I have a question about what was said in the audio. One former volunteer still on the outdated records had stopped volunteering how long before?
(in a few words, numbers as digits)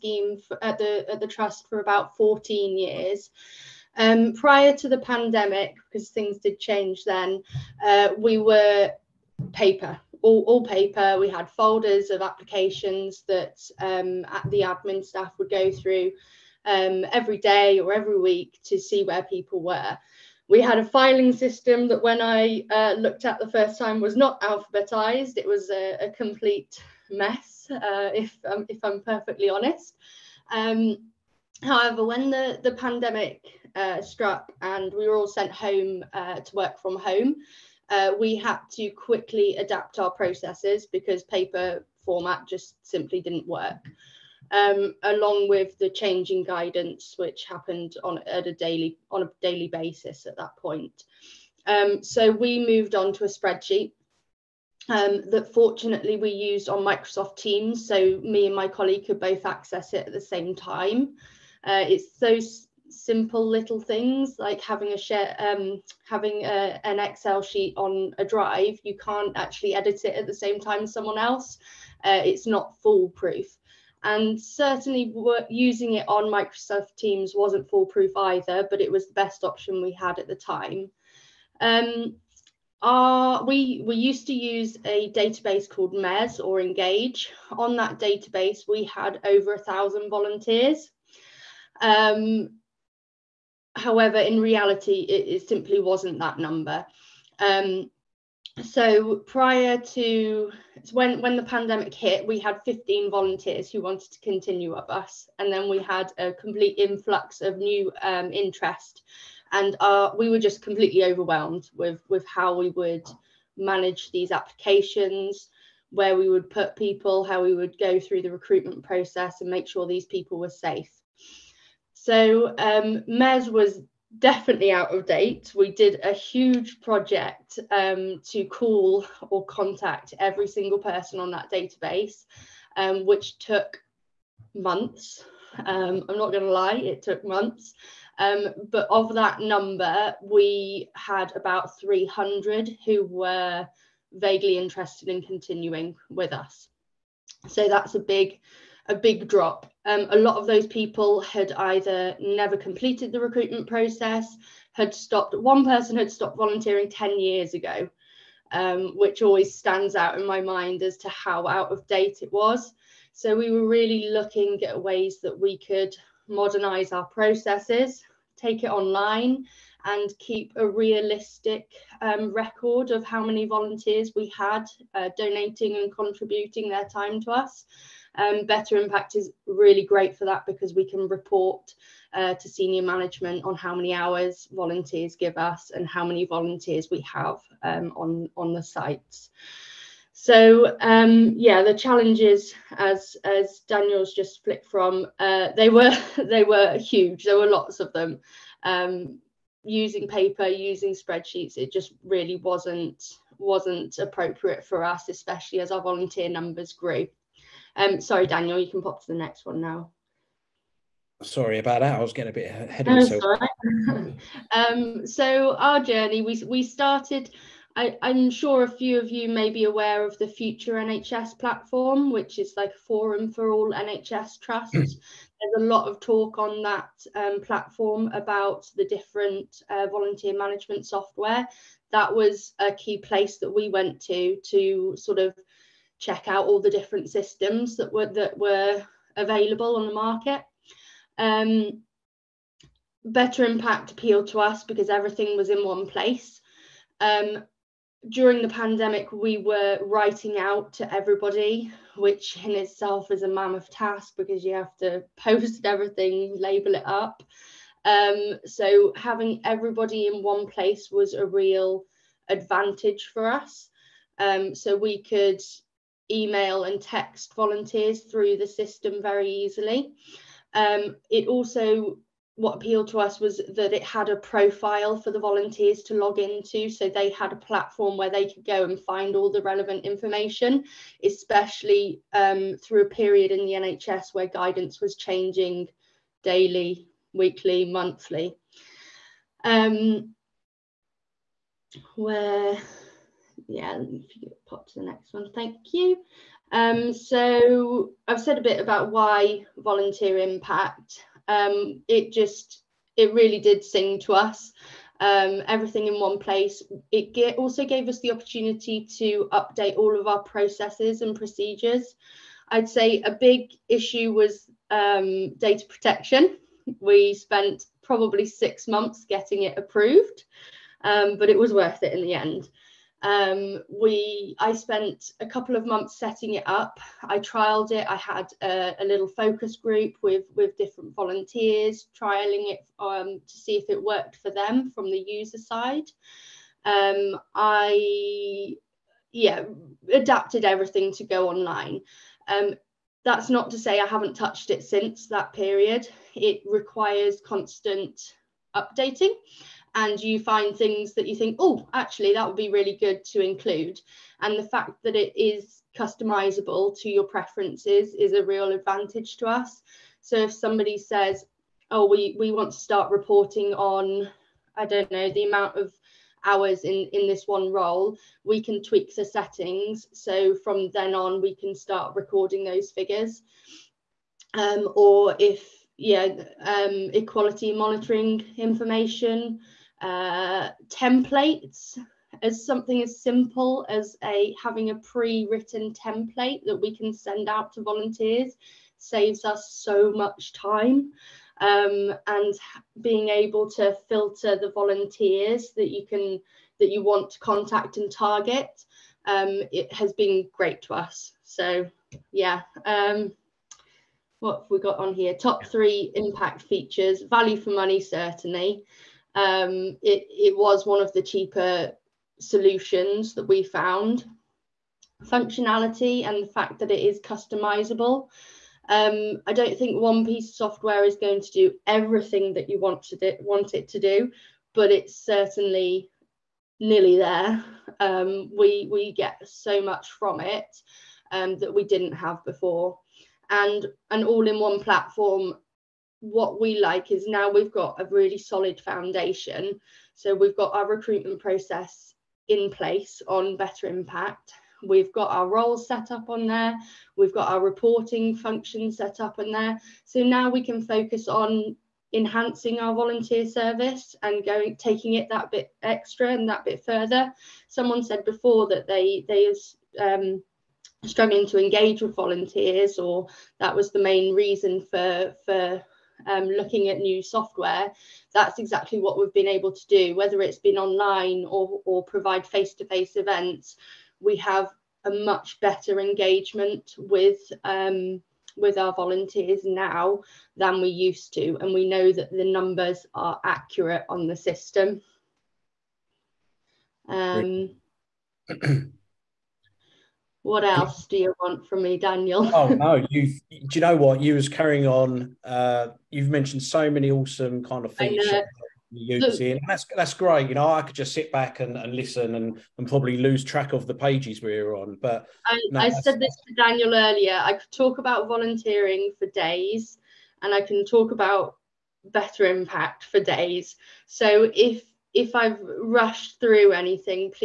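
10 years.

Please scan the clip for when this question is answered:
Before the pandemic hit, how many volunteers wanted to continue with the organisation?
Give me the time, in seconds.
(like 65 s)
102 s.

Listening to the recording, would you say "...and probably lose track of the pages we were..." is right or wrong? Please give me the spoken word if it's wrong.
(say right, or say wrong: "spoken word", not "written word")
right.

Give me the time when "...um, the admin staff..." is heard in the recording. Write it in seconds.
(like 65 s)
13 s.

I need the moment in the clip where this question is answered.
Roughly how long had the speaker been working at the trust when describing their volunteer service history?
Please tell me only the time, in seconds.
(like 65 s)
2 s.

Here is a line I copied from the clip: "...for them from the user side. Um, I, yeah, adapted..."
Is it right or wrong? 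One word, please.
right.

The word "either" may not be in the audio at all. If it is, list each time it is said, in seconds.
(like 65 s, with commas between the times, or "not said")
78 s, 151 s.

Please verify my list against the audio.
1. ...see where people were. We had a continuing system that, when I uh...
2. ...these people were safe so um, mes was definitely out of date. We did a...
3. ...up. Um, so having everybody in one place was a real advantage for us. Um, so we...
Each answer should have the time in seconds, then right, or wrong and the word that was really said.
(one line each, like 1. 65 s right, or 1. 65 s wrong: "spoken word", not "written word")
1. 18 s wrong: "filing", not "continuing"
2. 119 s right
3. 256 s right.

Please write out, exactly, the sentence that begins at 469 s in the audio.
Whether it's been online or, or provide face to face events, we have a much better engagement with.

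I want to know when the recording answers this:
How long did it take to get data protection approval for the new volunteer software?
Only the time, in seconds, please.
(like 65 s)
318 s.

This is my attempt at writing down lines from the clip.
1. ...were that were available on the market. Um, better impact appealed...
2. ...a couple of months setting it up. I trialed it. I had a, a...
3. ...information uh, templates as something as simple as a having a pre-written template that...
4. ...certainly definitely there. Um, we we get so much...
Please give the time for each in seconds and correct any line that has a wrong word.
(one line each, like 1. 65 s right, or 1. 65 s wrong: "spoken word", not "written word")
1. 237 s right
2. 325 s right
3. 378 s right
4. 424 s wrong: "nearly", not "definitely".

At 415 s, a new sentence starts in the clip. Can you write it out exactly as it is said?
Functionality and the fact that it is customizable.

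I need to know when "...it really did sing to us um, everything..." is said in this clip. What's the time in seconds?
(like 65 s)
302 s.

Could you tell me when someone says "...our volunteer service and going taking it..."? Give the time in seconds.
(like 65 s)
452 s.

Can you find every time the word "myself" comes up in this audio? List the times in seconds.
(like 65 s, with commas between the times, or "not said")
212 s.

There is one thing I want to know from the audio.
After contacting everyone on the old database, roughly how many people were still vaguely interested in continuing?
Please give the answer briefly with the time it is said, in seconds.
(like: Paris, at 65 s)
300, at 141 s.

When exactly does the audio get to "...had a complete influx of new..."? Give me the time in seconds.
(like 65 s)
105 s.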